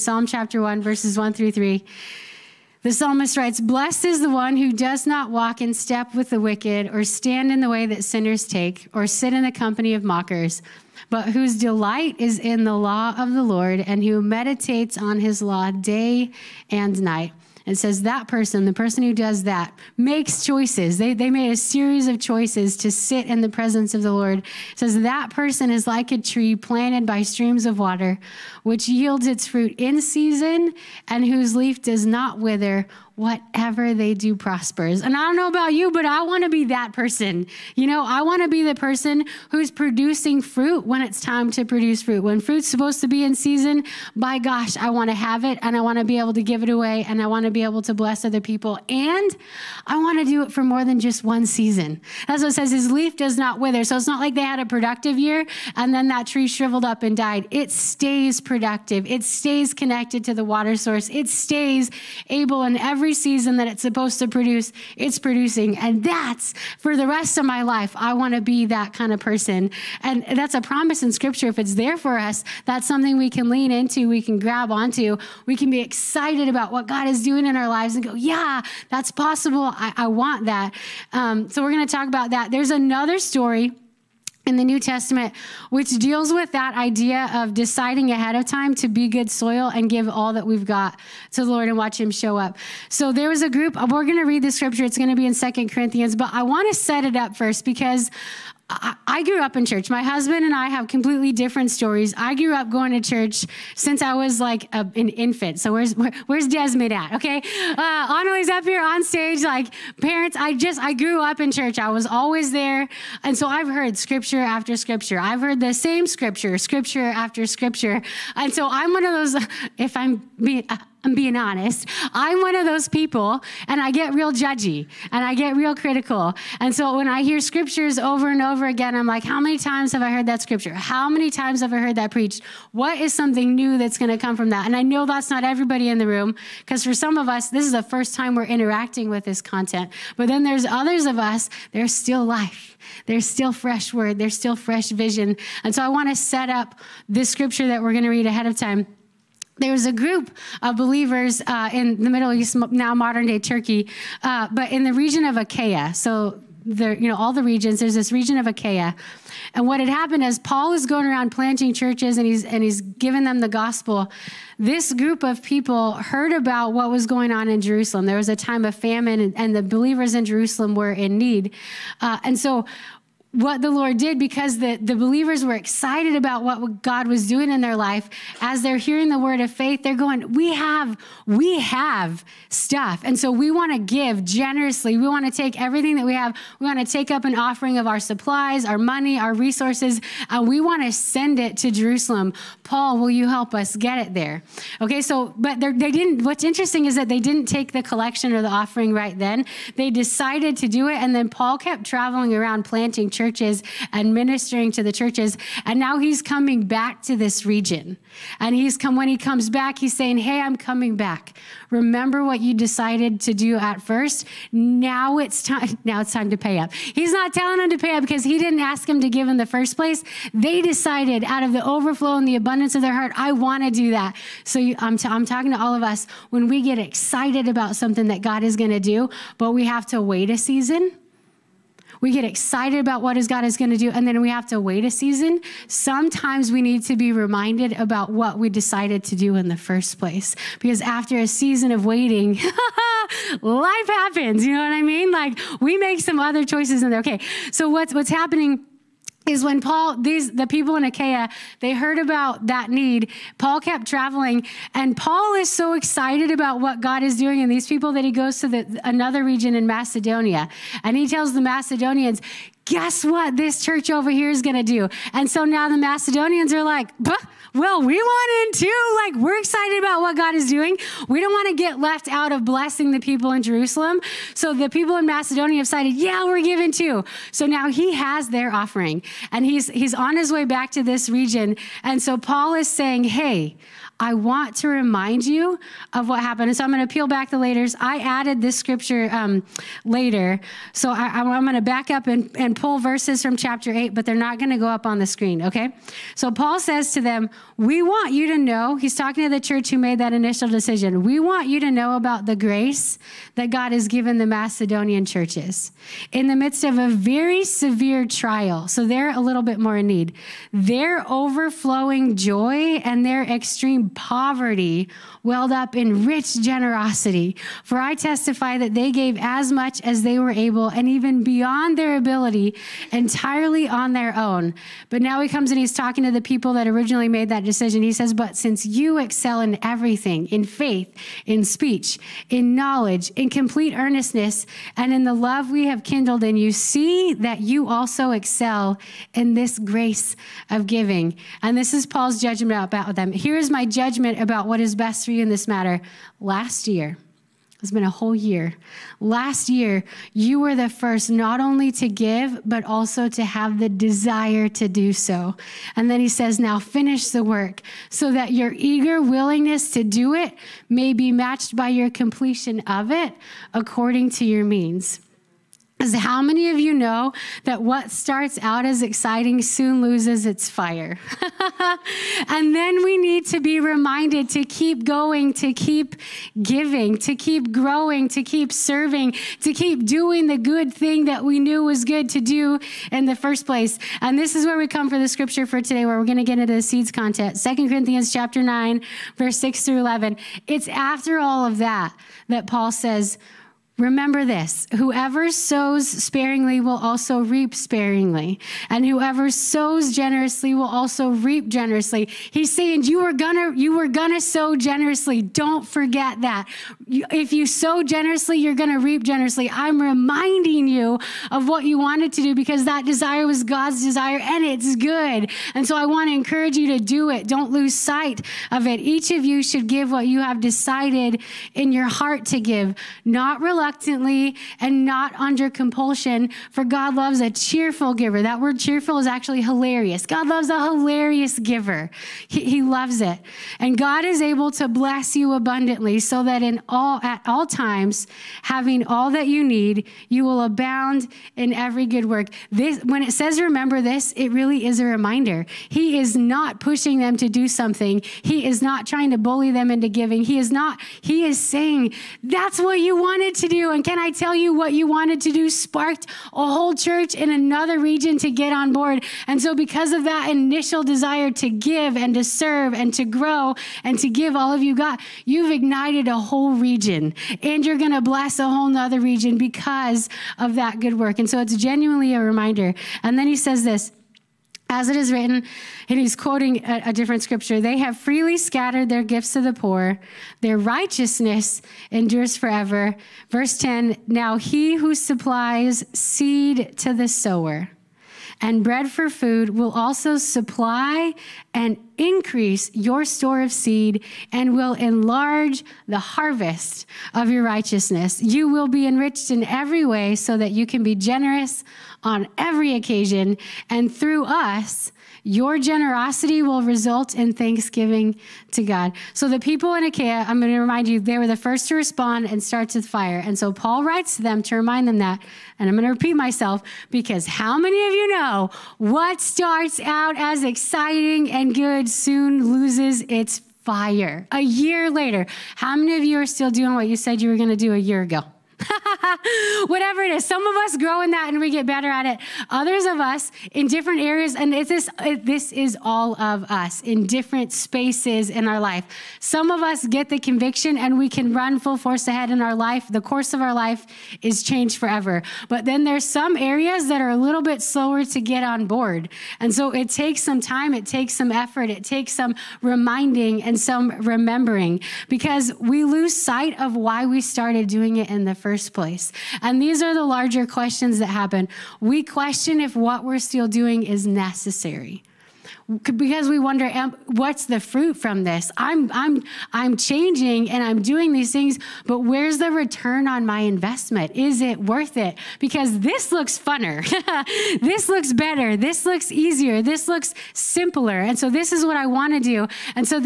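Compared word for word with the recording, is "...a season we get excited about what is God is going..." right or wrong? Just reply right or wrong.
right.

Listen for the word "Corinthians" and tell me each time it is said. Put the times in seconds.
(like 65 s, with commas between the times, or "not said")
95 s, 387 s.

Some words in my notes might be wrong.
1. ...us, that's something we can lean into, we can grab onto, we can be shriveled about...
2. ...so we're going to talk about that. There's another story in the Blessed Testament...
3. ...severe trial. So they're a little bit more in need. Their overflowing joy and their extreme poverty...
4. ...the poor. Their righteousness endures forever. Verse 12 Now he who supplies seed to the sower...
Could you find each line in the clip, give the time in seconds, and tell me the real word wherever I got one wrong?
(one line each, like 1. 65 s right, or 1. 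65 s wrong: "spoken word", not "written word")
1. 72 s wrong: "excited", not "shriveled"
2. 81 s wrong: "New", not "Blessed"
3. 307 s right
4. 479 s wrong: "10", not "12".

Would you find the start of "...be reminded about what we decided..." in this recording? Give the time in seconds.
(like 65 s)
236 s.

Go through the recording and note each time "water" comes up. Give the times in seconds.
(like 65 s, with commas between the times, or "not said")
27 s, 60 s.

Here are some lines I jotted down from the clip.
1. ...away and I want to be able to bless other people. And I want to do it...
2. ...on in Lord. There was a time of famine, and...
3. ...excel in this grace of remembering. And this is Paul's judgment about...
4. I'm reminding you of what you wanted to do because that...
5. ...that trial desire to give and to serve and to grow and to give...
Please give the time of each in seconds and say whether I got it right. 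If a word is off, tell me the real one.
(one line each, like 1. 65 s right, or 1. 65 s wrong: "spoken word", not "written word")
1. 46 s right
2. 167 s wrong: "Jerusalem", not "Lord"
3. 338 s wrong: "giving", not "remembering"
4. 409 s right
5. 460 s wrong: "initial", not "trial".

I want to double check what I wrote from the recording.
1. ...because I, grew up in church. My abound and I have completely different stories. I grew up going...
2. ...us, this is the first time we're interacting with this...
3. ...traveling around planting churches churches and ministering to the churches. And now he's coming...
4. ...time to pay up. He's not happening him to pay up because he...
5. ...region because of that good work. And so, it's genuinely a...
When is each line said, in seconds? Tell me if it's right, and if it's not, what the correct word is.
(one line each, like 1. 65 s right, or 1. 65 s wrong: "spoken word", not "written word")
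1. 97 s wrong: "husband", not "abound"
2. 137 s right
3. 201 s right
4. 216 s wrong: "telling", not "happening"
5. 468 s right.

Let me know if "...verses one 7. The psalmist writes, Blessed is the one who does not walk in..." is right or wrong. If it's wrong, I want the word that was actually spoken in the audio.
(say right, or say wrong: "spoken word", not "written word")
wrong: "3", not "7".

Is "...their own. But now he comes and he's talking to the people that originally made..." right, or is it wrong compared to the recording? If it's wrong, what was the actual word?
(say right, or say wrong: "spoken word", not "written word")
right.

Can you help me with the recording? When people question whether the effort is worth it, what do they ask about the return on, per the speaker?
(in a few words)
my investment.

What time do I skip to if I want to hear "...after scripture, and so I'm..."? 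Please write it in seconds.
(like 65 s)
117 s.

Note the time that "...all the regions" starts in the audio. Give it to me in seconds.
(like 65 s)
157 s.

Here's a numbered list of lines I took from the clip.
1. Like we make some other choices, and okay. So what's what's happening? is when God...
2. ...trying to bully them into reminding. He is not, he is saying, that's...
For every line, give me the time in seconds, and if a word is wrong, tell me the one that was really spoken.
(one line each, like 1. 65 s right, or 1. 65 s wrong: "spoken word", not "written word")
1. 245 s wrong: "Paul", not "God"
2. 448 s wrong: "giving", not "reminding".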